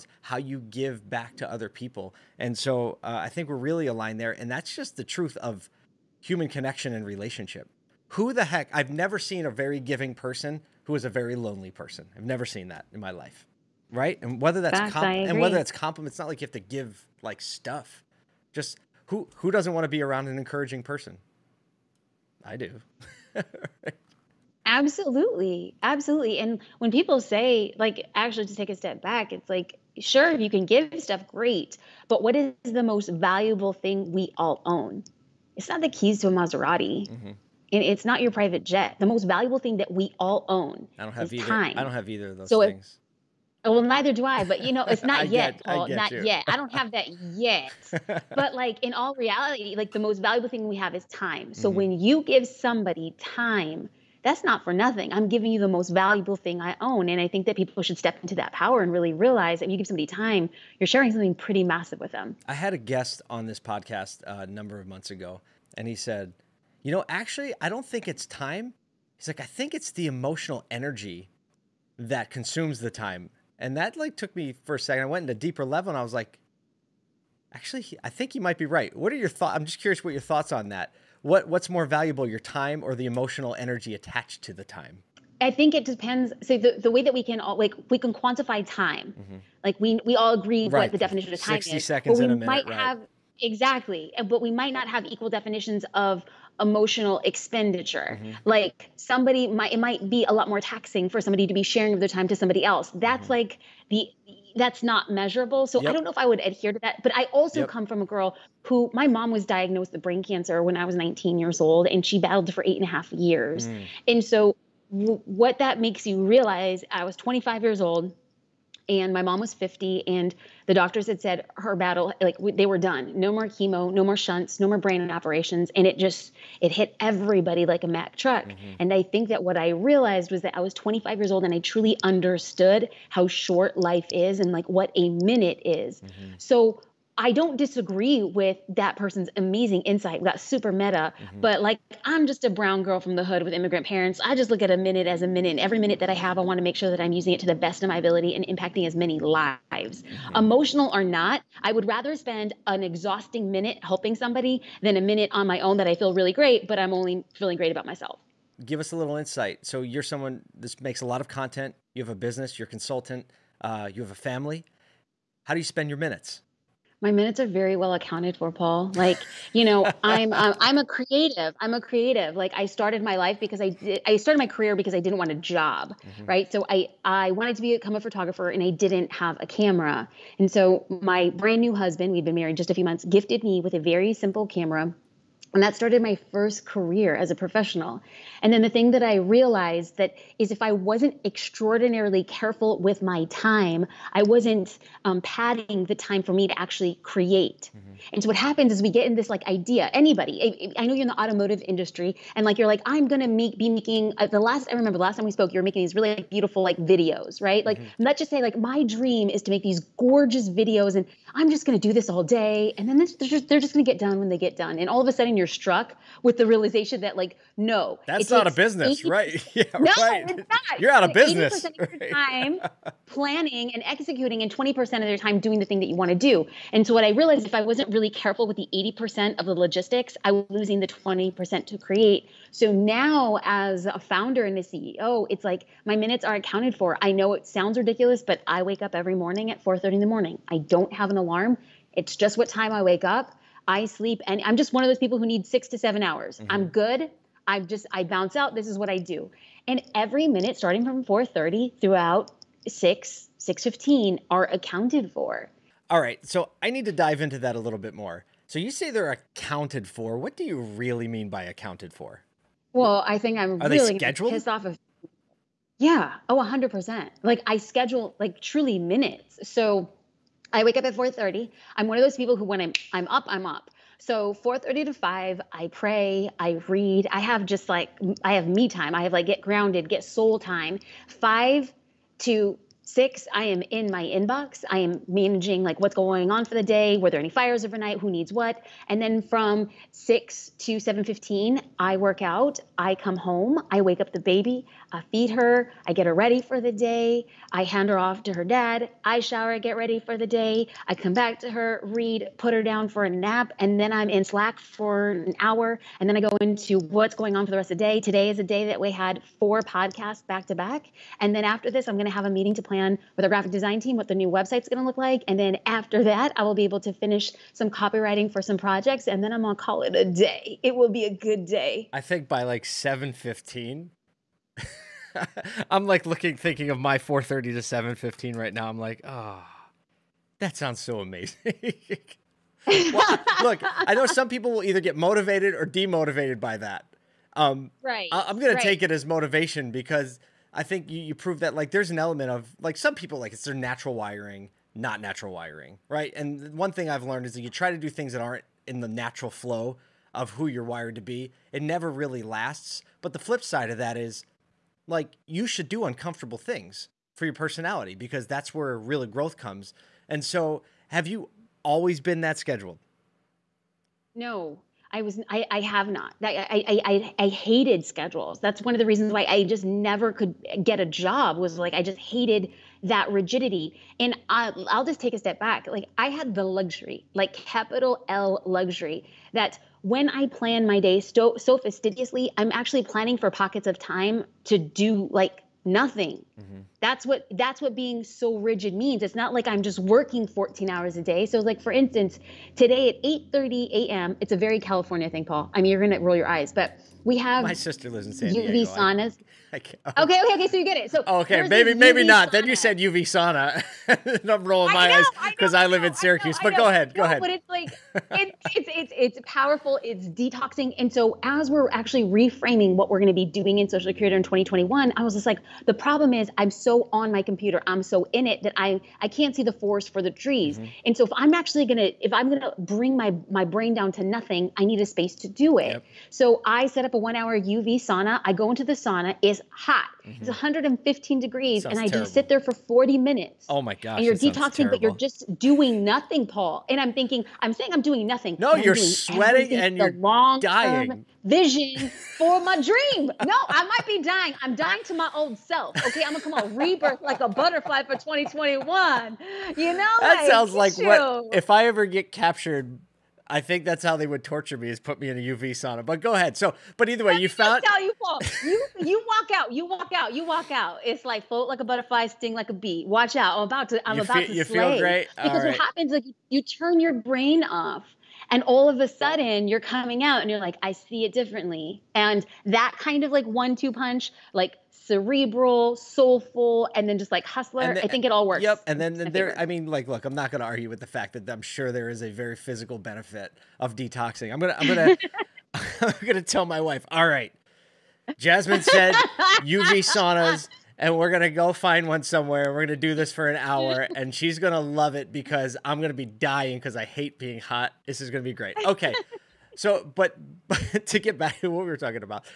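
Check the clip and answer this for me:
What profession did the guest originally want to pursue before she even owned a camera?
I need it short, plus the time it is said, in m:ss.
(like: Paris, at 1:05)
Photographer, at 2:57.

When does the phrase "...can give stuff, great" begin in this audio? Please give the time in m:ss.
0:30.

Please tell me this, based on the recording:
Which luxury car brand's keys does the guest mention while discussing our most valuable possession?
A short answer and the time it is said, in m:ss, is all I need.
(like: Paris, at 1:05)
Maserati, at 0:36.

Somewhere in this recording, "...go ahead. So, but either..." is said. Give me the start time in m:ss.
7:36.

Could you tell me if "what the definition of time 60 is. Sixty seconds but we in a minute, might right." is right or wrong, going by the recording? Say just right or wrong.
right.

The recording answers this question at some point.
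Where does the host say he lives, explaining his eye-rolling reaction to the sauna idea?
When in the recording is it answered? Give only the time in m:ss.
6:45.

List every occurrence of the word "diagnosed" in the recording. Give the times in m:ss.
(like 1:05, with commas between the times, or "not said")
1:49.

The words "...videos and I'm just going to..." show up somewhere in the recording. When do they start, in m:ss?
3:30.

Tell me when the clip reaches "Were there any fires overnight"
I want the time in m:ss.
4:46.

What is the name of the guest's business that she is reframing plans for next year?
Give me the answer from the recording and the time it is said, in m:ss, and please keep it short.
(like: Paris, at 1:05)
Social Curator, at 6:53.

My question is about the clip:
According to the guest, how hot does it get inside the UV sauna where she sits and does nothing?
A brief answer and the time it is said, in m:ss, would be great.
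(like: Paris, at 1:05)
115 degrees, at 7:10.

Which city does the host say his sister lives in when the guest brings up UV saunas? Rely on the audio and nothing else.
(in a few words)
San Diego.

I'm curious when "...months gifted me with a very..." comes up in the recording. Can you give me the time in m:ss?
3:02.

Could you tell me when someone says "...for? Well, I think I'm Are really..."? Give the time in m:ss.
4:21.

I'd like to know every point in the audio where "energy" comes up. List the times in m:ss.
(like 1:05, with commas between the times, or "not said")
1:10, 1:23.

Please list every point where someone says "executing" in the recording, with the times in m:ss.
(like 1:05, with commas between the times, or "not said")
3:43.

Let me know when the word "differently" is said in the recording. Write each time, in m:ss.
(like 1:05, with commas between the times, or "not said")
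7:51.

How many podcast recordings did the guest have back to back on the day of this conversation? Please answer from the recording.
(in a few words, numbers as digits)
4.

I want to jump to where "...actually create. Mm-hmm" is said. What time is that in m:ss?
3:16.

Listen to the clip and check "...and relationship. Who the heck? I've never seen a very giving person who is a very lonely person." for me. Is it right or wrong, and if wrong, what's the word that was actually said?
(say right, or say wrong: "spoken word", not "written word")
right.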